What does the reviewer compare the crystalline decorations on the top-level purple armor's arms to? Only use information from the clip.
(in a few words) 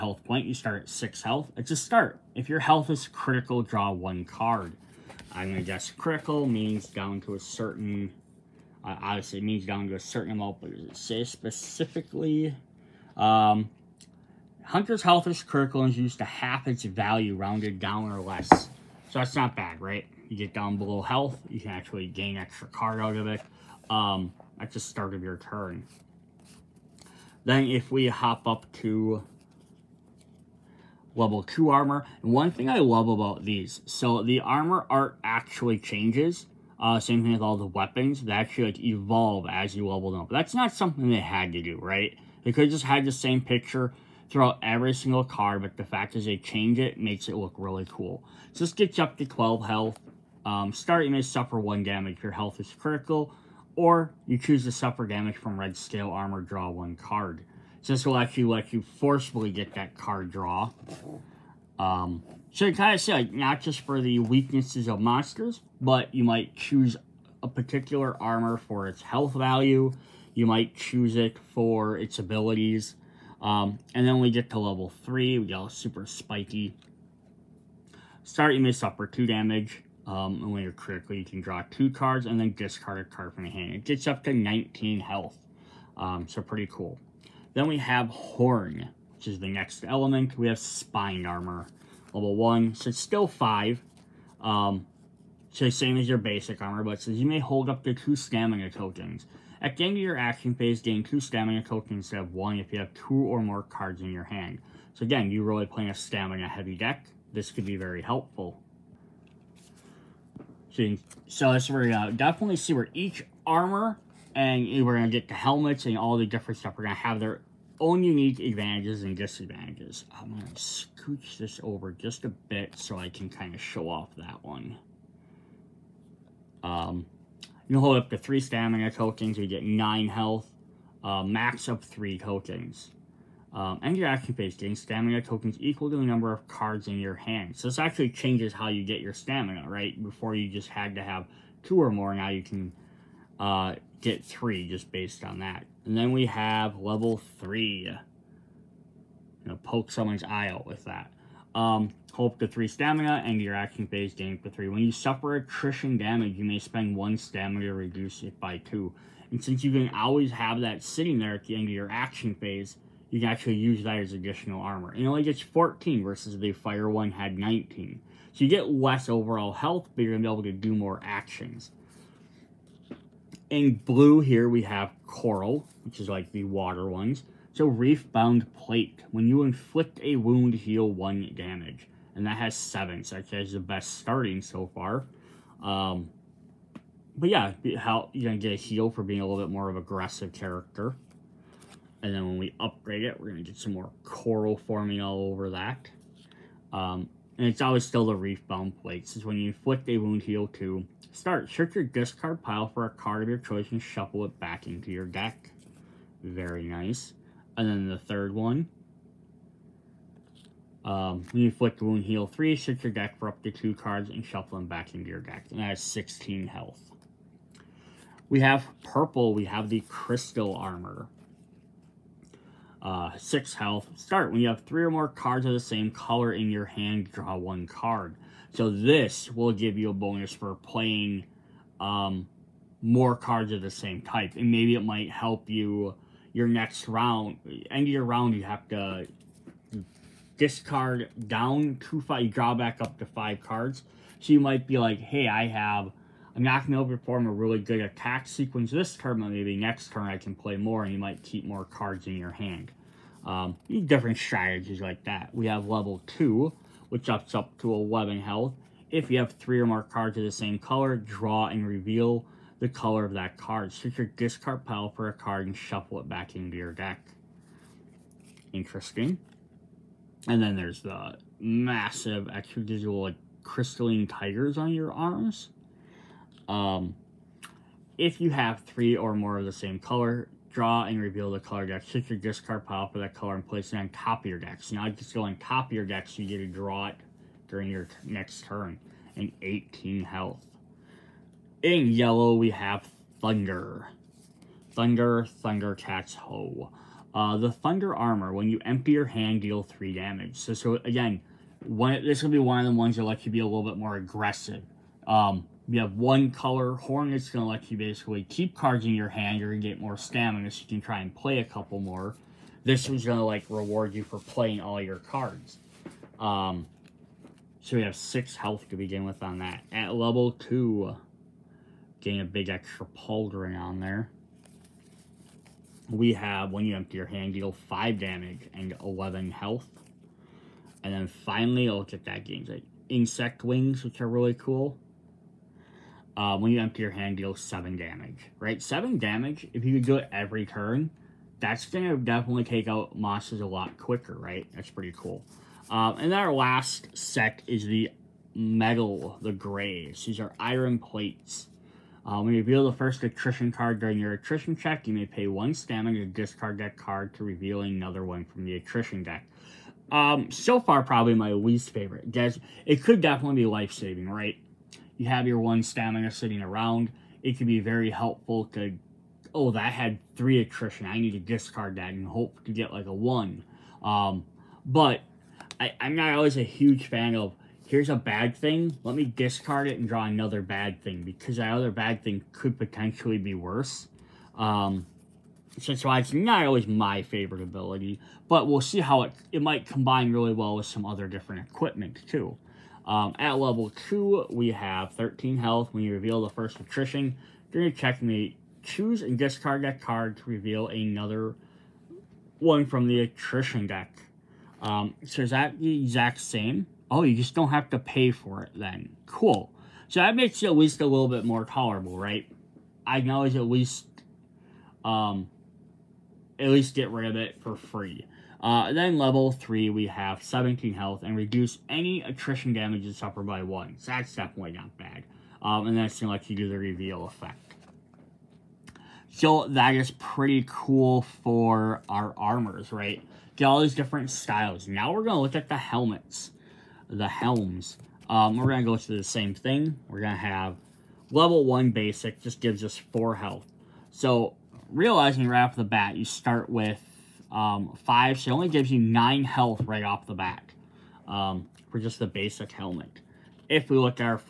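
tigers.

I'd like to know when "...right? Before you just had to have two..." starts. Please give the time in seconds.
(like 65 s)
139 s.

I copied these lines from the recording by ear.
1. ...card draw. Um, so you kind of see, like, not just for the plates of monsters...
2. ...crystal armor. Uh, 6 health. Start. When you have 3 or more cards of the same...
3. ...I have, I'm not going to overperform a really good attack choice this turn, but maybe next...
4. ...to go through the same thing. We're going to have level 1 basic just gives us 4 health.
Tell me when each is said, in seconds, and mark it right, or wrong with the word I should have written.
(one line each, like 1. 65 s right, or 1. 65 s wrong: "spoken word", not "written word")
1. 59 s wrong: "weaknesses", not "plates"
2. 219 s right
3. 245 s wrong: "sequence", not "choice"
4. 438 s right.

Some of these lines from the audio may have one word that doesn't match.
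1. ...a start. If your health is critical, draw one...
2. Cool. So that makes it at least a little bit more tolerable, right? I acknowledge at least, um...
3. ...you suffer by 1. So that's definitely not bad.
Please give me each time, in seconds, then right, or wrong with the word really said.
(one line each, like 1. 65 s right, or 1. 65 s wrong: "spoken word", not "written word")
1. 1 s right
2. 409 s right
3. 422 s right.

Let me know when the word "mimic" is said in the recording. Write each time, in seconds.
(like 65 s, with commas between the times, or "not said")
not said.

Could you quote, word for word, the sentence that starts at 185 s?
Um, but yeah, how you're going to get a heal for being a little bit more of aggressive character.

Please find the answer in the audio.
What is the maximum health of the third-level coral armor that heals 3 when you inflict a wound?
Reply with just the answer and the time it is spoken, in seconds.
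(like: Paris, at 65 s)
16, at 215 s.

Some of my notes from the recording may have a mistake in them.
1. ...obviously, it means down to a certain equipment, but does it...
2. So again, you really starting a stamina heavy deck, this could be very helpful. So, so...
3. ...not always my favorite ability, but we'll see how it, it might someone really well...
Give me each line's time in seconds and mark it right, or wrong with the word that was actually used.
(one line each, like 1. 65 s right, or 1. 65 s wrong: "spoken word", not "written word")
1. 9 s wrong: "amount", not "equipment"
2. 104 s wrong: "playing", not "starting"
3. 386 s wrong: "combine", not "someone".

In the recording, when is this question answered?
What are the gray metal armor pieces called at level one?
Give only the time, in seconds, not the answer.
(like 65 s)
350 s.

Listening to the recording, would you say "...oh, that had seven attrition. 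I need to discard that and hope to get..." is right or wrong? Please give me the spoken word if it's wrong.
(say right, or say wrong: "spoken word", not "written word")
wrong: "three", not "seven".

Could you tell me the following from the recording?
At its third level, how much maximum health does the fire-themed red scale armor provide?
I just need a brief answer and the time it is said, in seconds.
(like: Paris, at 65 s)
19, at 84 s.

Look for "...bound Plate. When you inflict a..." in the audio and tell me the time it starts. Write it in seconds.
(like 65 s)
178 s.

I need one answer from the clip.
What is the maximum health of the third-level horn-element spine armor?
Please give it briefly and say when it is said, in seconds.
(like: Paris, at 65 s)
14, at 165 s.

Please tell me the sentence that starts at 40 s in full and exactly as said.
That's not something they had to do, right?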